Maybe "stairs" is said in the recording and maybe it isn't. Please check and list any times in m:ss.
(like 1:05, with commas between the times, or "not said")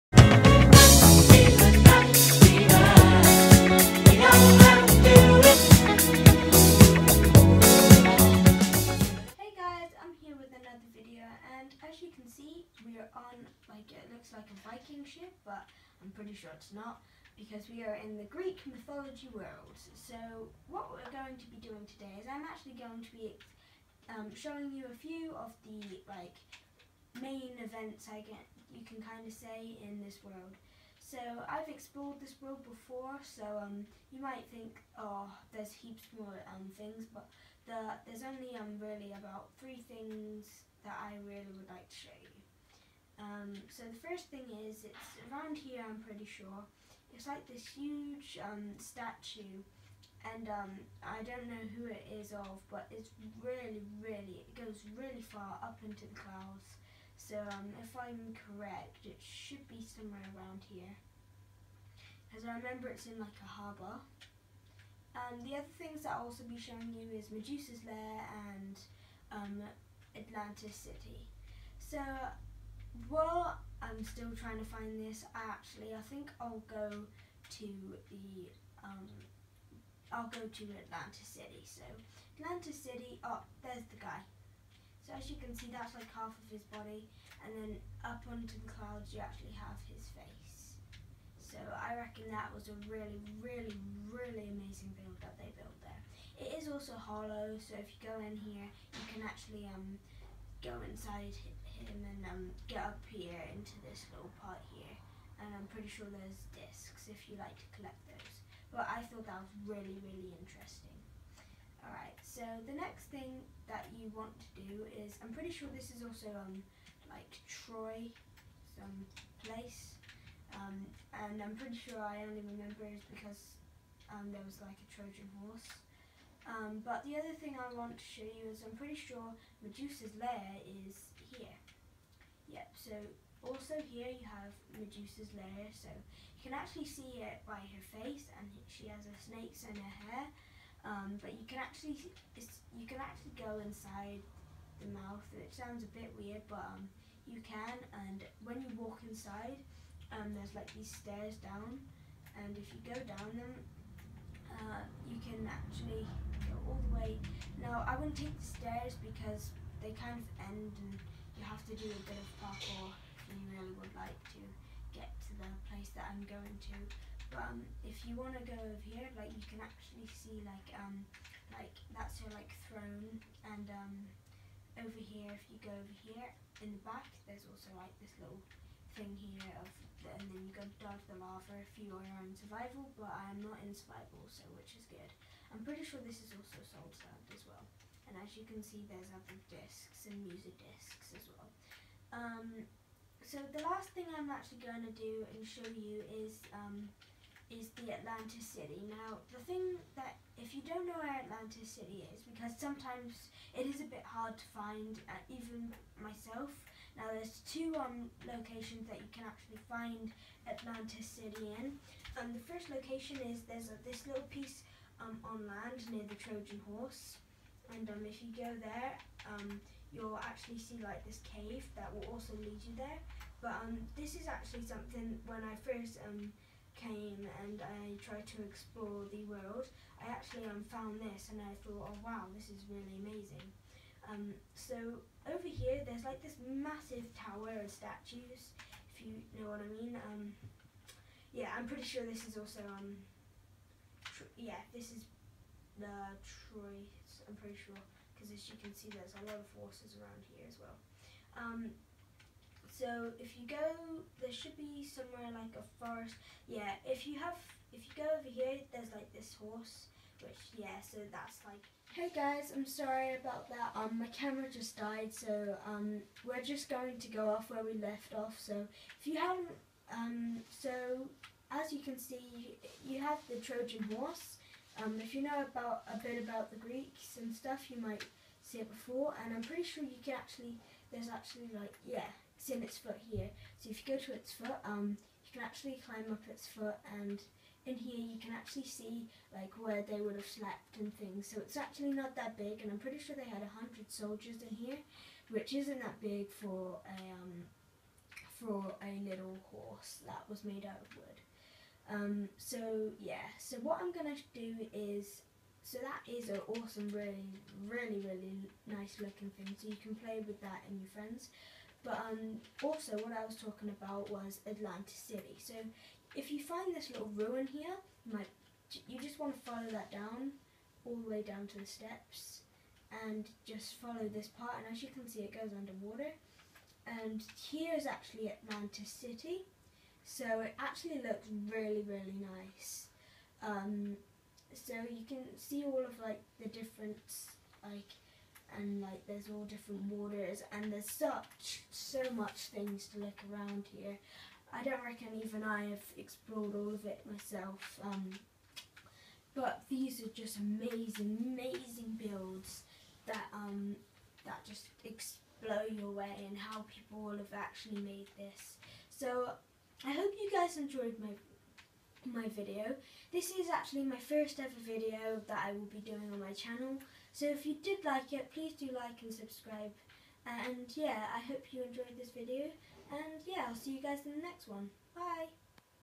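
2:30, 2:38.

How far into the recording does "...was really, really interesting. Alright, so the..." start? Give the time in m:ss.
1:49.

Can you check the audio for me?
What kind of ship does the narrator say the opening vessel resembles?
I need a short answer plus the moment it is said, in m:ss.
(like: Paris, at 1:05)
Viking ship, at 0:14.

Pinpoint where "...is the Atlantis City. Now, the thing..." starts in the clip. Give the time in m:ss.
3:17.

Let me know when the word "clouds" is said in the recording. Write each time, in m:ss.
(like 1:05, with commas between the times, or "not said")
0:56, 1:28.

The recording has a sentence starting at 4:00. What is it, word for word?
Um, yeah, I'm pretty sure this is also um, yeah, this is the Troy.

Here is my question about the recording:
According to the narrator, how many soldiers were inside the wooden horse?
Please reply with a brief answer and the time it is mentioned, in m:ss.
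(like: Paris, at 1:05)
100, at 4:53.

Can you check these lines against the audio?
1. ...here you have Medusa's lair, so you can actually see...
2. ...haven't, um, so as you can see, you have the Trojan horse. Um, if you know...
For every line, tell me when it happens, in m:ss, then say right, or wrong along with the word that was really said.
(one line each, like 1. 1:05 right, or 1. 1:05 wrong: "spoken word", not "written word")
1. 2:13 right
2. 4:29 right.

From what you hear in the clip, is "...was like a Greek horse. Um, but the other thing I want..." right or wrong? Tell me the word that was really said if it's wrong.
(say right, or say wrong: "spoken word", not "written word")
wrong: "Trojan", not "Greek".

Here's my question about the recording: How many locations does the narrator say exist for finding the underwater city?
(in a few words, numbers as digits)
2.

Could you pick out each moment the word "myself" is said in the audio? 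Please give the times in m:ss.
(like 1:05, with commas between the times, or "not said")
3:25, 5:47.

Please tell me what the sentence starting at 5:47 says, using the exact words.
Um, but these are just amazing, amazing builds that um, that just blow your away and how people have actually made this.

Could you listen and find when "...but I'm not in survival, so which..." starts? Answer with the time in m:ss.
3:02.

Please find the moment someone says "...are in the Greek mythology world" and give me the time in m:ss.
0:17.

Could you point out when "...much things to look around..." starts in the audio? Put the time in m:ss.
5:42.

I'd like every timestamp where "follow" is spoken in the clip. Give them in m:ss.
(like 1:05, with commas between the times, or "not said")
5:19, 5:23.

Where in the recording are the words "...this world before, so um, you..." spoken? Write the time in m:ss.
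0:32.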